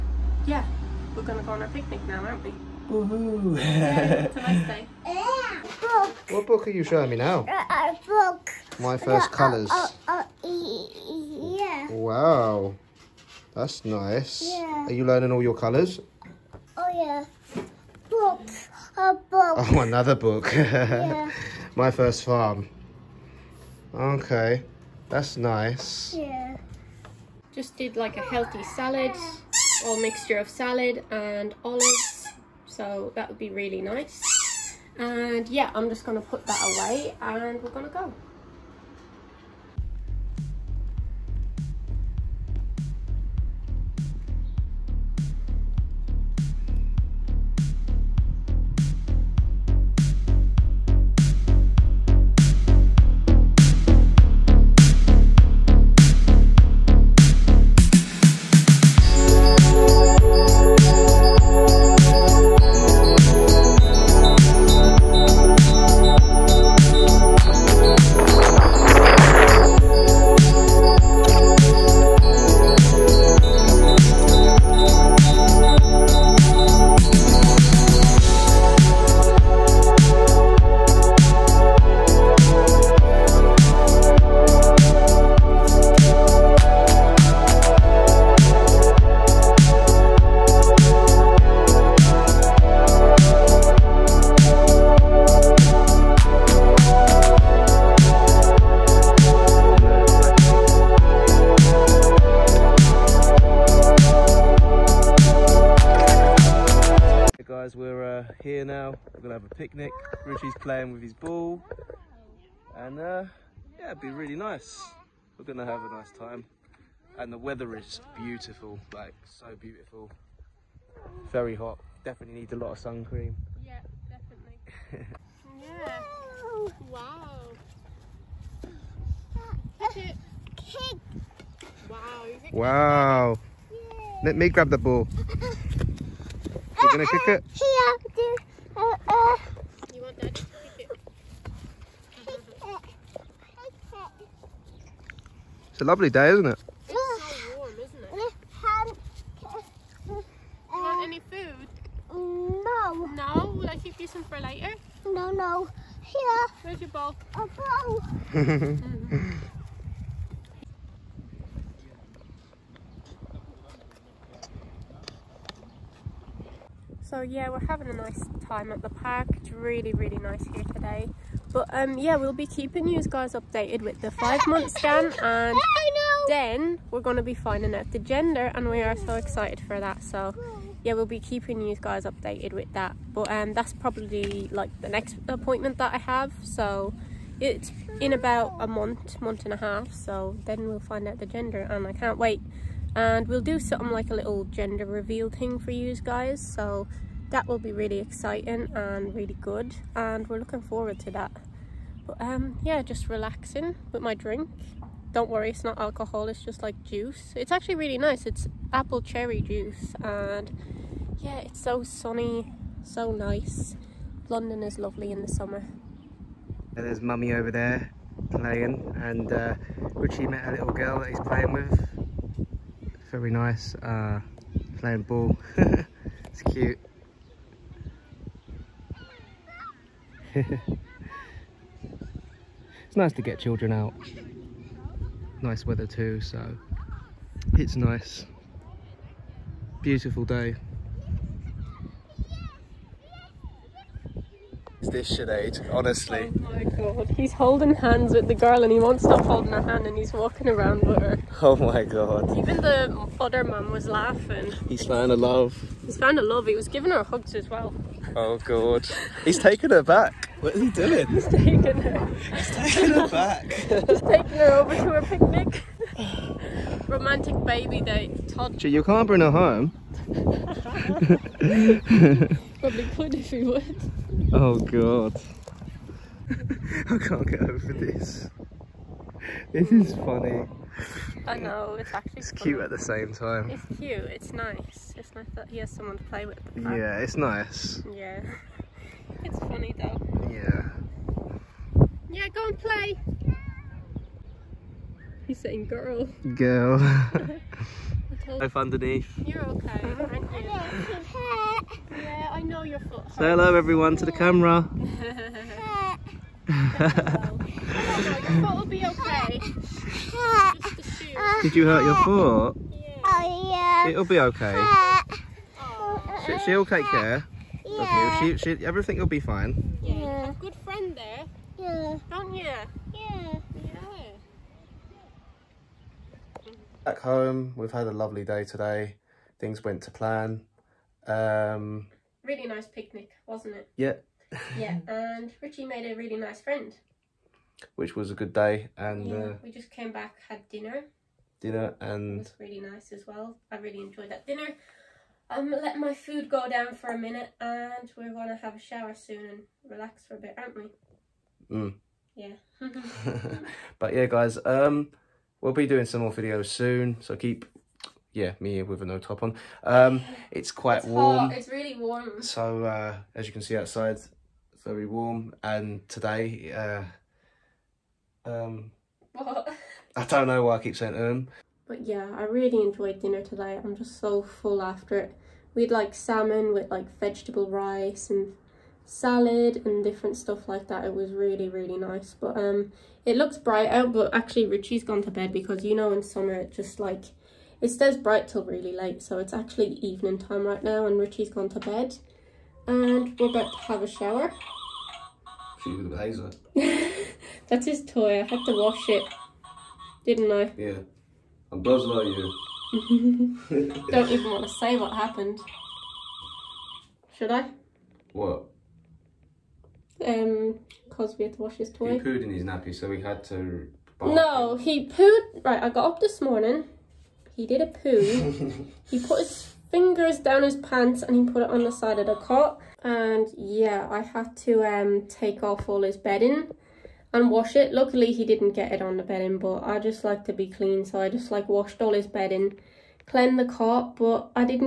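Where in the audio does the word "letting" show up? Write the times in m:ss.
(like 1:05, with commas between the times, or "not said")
5:45.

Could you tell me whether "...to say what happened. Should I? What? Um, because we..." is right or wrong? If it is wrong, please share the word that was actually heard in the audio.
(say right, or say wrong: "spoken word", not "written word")
right.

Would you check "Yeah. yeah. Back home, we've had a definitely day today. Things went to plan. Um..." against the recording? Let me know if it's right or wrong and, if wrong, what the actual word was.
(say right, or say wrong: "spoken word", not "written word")
wrong: "lovely", not "definitely".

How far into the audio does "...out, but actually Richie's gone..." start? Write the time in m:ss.
6:23.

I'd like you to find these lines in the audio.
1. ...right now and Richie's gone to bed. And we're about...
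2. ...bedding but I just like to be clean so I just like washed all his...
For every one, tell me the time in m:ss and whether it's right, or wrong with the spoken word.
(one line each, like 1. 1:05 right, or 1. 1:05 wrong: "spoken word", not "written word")
1. 6:30 right
2. 7:09 right.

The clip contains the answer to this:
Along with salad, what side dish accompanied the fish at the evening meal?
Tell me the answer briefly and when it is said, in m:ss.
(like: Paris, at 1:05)
Vegetable rice, at 6:16.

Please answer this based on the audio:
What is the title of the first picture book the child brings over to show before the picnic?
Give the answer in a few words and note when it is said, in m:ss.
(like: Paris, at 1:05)
My first colours, at 0:08.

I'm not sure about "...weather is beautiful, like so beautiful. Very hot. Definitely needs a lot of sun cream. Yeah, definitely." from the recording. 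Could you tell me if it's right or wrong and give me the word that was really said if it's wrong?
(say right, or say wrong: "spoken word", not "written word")
right.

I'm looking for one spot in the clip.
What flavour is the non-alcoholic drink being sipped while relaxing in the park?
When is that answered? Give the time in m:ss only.
3:28.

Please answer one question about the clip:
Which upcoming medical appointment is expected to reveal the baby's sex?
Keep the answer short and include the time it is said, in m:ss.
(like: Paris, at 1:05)
Five month scan, at 2:54.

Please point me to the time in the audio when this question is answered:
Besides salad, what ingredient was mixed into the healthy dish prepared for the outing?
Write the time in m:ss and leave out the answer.
0:31.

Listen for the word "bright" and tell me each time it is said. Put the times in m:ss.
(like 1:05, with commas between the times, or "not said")
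6:23, 6:27.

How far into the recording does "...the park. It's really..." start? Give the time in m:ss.
2:48.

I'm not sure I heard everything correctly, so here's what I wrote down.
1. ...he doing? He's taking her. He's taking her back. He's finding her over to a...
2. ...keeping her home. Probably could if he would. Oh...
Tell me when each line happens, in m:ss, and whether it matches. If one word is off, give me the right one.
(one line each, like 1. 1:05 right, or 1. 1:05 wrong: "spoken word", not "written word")
1. 4:20 wrong: "taking", not "finding"
2. 4:29 wrong: "bring", not "keeping".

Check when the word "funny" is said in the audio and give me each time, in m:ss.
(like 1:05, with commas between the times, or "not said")
4:39, 4:49.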